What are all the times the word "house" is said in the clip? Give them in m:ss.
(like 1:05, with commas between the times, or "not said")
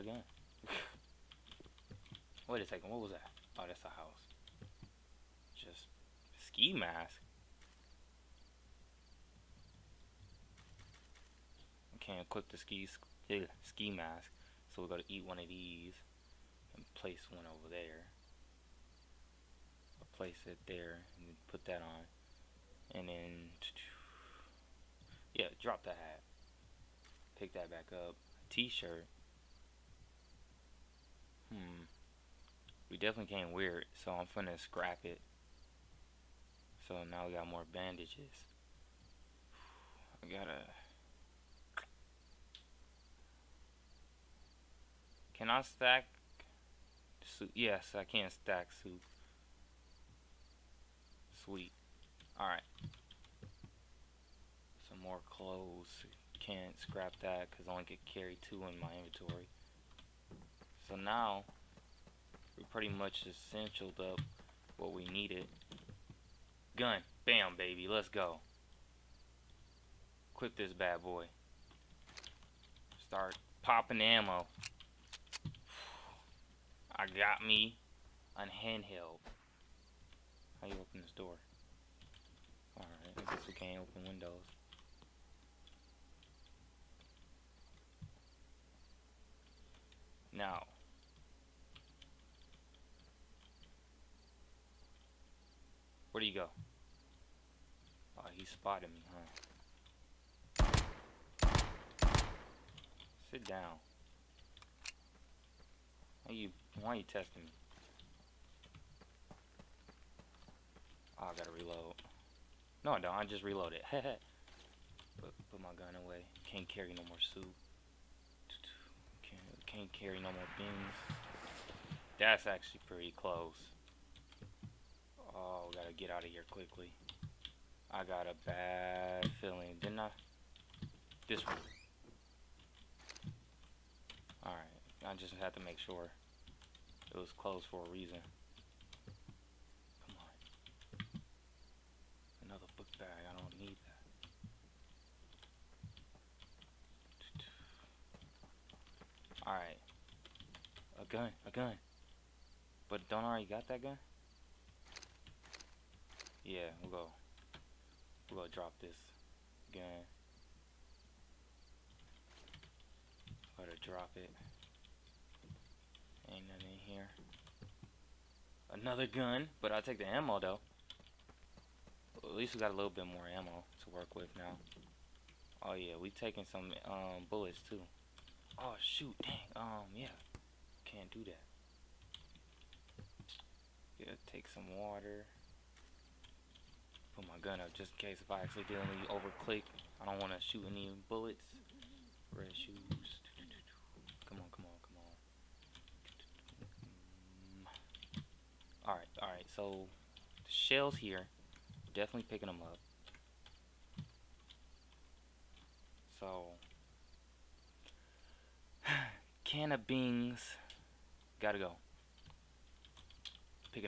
0:03.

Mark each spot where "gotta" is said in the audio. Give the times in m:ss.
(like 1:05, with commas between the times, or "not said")
0:14, 0:40, 1:51, 2:05, 2:43, 3:31.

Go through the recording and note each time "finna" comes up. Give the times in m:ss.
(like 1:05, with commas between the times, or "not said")
0:34.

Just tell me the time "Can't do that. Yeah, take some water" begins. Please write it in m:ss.
3:00.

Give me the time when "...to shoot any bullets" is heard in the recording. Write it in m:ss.
3:10.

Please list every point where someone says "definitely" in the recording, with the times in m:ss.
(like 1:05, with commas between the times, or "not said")
0:32, 3:21.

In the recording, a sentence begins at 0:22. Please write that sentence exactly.
And then, yeah, drop the hat.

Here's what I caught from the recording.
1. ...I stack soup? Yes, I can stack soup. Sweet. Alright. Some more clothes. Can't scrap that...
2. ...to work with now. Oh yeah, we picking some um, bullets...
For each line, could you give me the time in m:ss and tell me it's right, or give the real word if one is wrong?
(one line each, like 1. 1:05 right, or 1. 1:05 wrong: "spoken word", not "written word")
1. 0:45 right
2. 2:53 wrong: "taking", not "picking".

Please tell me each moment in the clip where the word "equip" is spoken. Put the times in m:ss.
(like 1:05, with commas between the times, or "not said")
0:12, 1:10.